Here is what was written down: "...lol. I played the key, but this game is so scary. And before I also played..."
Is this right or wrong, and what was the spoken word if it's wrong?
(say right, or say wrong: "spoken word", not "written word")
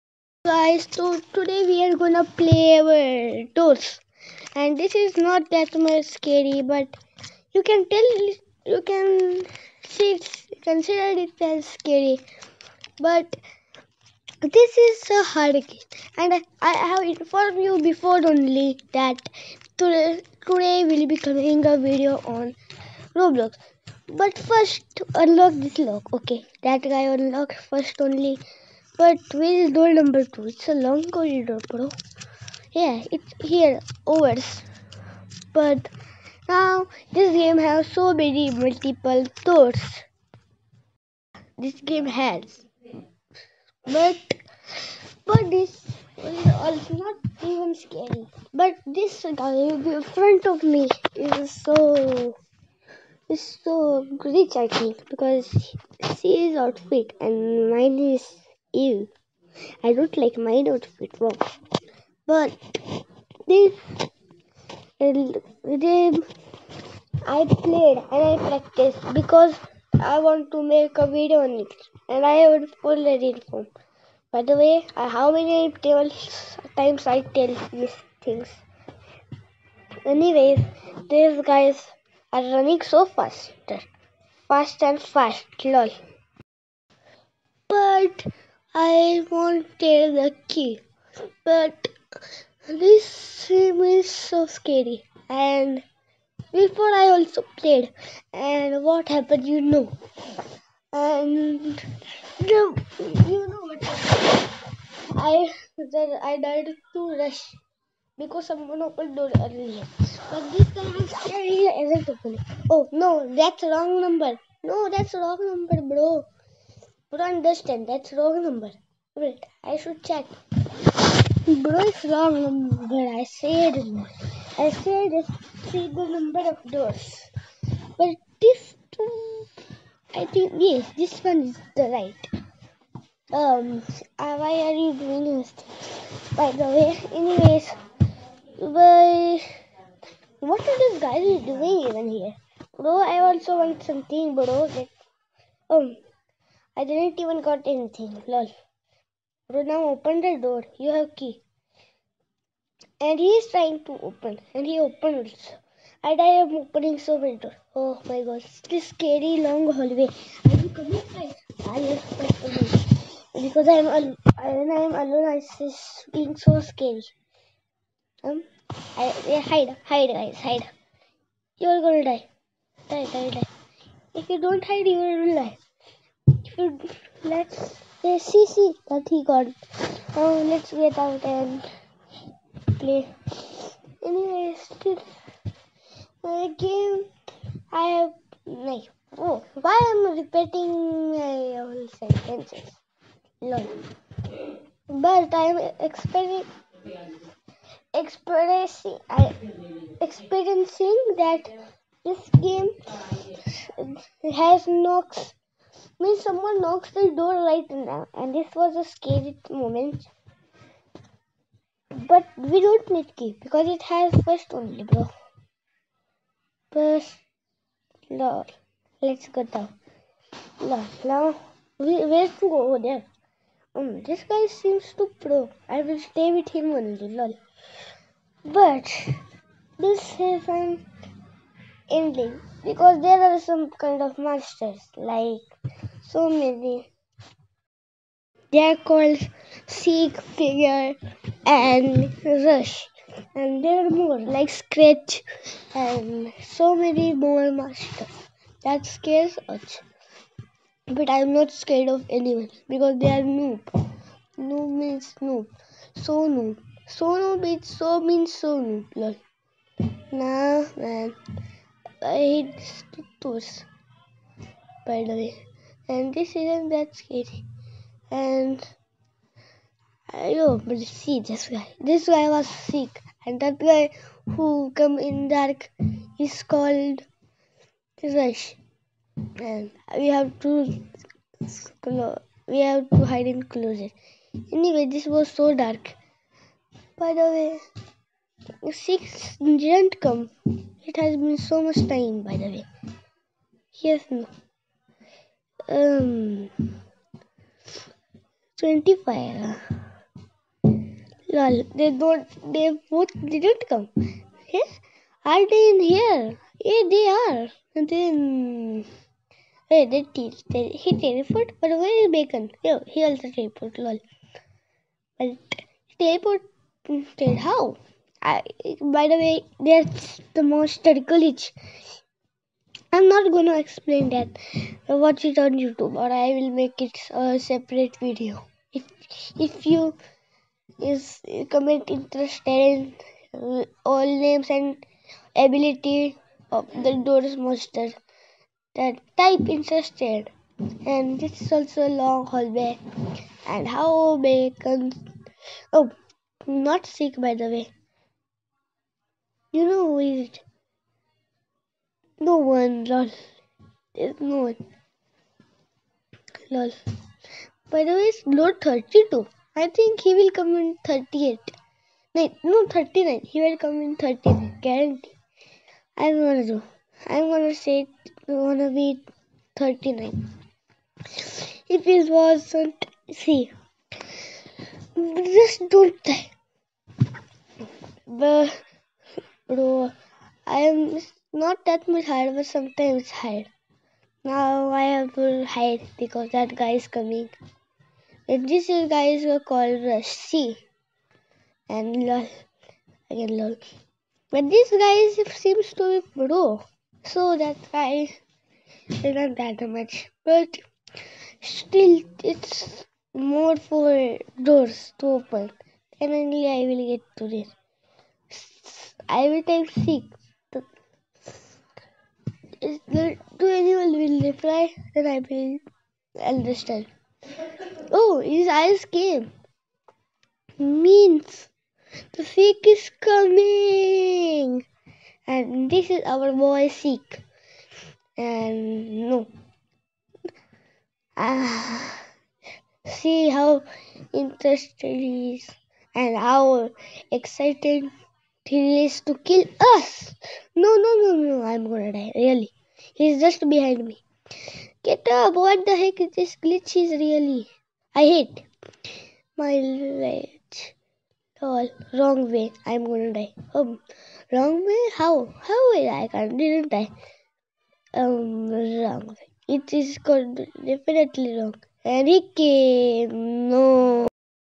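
wrong: "wanted", not "played".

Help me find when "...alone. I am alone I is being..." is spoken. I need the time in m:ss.
2:43.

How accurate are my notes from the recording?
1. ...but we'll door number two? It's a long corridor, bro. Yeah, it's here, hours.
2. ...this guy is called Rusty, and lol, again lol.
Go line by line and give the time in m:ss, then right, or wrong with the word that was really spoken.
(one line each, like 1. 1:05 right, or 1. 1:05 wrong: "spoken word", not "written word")
1. 0:29 right
2. 6:28 right.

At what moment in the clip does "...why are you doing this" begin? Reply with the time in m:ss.
2:14.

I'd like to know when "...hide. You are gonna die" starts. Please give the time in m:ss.
2:50.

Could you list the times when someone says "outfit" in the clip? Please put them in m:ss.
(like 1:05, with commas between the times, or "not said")
0:56, 1:00.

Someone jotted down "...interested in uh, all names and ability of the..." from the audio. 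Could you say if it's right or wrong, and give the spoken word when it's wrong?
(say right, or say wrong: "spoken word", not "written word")
right.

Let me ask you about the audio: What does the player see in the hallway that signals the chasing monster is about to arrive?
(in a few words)
his eyes.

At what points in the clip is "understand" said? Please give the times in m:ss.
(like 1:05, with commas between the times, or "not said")
1:57, 6:56.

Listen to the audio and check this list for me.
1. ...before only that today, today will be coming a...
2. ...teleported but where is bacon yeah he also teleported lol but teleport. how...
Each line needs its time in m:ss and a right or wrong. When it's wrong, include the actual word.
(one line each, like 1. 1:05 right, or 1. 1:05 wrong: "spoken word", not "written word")
1. 0:17 right
2. 5:11 right.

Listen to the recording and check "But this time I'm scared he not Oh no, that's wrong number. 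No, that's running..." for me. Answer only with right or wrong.
wrong.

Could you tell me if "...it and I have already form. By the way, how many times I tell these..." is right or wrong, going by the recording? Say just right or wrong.
right.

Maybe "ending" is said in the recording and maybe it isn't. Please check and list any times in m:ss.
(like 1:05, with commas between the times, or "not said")
3:51.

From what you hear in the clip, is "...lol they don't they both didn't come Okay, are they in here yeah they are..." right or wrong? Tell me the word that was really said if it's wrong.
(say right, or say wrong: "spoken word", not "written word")
right.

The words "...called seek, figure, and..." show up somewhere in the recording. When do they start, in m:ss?
3:58.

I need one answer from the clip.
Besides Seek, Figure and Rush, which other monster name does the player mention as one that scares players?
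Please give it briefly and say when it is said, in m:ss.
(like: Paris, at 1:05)
Scratch, at 4:04.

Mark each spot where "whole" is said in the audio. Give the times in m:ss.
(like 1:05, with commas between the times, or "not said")
3:11.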